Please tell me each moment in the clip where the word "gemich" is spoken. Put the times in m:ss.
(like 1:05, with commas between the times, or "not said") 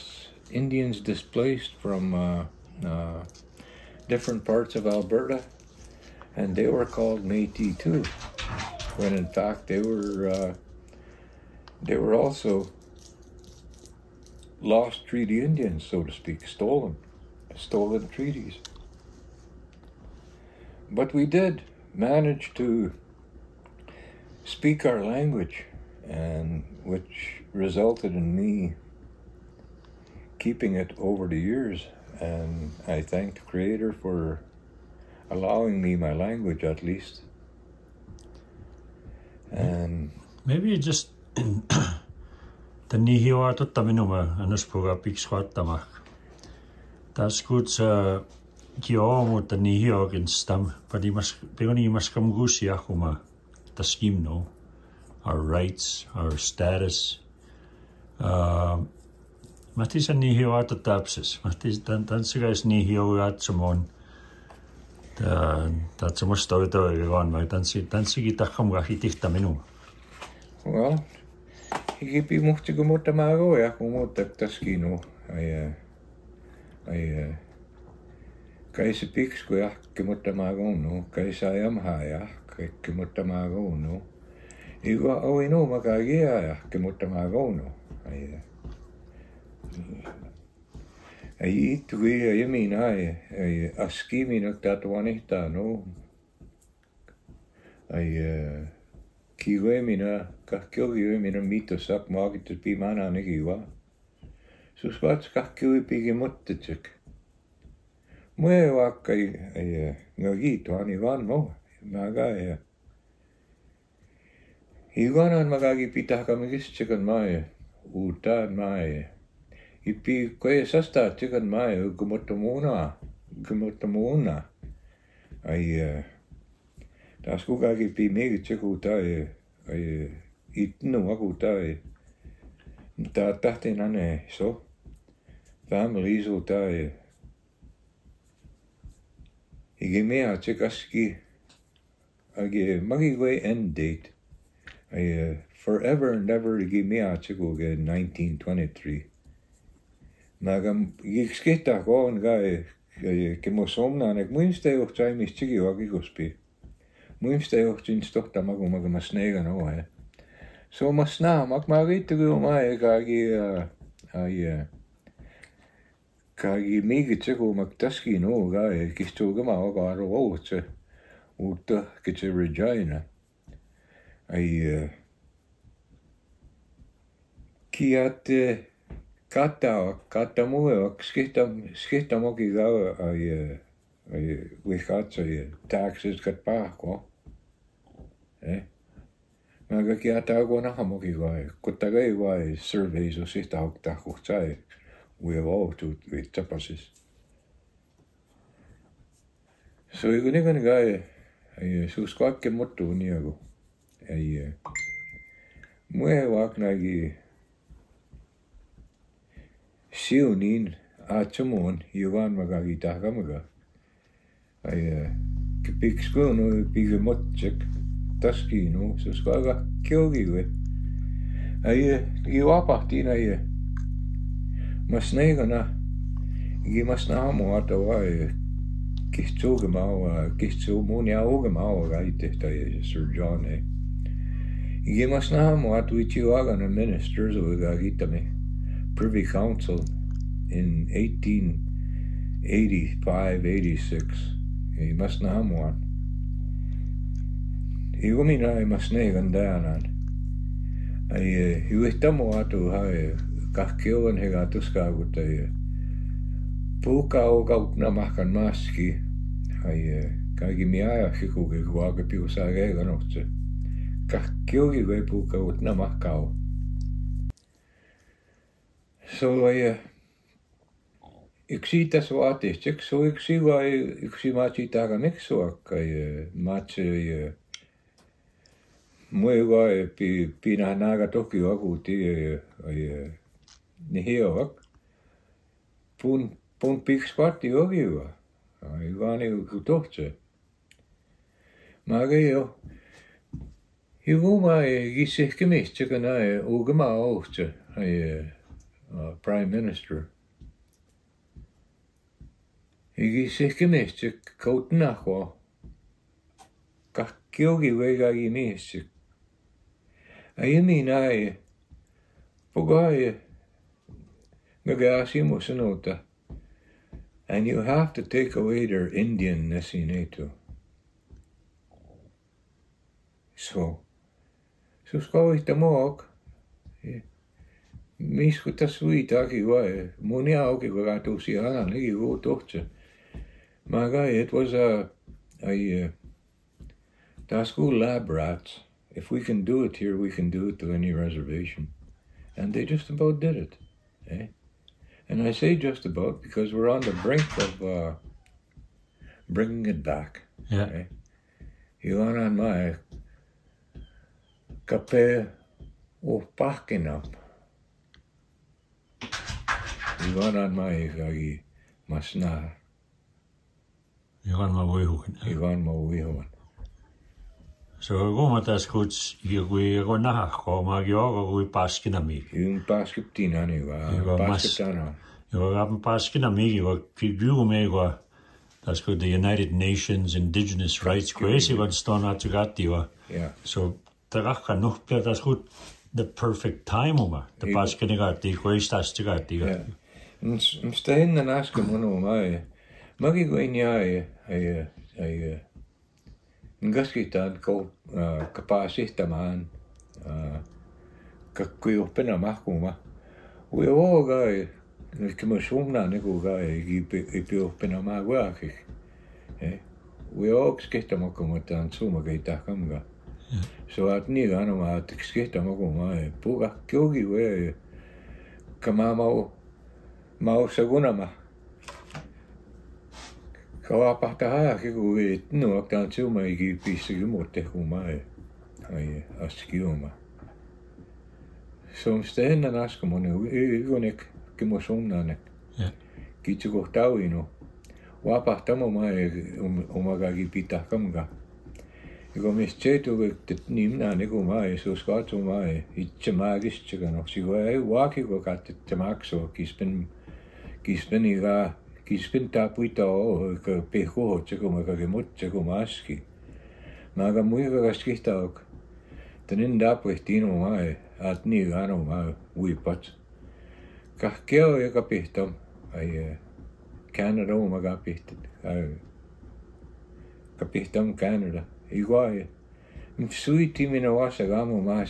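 4:55, 5:03.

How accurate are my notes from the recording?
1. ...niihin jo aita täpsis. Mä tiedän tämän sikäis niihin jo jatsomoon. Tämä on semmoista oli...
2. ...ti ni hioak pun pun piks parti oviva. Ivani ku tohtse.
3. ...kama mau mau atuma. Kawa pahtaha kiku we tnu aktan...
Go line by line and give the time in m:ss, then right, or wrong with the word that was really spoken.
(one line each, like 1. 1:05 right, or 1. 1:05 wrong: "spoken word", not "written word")
1. 1:00 right
2. 4:41 right
3. 6:58 wrong: "sagunama", not "atuma".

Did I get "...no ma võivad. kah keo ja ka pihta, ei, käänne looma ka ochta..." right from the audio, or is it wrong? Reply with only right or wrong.
wrong.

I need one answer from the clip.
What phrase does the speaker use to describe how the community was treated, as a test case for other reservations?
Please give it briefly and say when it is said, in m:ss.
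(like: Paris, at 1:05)
lab rats, at 5:37.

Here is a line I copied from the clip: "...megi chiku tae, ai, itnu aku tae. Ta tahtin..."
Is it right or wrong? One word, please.
right.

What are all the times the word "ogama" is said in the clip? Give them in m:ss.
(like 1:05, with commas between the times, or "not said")
4:56.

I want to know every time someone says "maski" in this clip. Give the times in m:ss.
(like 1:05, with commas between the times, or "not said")
4:18, 7:35.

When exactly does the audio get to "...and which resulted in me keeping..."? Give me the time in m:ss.
0:26.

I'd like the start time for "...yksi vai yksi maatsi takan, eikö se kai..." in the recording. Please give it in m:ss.
4:32.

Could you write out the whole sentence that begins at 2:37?
Muistejuht siin tohta magu magu ma snega no nagu, he.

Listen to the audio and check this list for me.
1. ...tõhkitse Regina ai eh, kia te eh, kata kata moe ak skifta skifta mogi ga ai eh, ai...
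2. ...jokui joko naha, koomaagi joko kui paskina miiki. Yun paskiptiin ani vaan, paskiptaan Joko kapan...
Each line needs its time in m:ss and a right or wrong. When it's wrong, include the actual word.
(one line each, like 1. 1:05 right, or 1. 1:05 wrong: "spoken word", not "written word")
1. 2:51 right
2. 6:09 right.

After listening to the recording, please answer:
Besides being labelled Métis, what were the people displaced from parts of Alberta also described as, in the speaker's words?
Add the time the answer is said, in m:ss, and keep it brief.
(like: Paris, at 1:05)
lost treaty Indians, at 0:14.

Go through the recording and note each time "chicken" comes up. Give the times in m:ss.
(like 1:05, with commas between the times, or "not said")
1:56, 2:01, 4:55.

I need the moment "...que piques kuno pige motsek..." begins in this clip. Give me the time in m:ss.
3:35.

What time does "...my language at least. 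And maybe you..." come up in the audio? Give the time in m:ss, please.
0:35.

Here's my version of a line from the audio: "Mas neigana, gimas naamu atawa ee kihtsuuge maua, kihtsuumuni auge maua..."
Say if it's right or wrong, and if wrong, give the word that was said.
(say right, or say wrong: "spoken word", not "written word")
right.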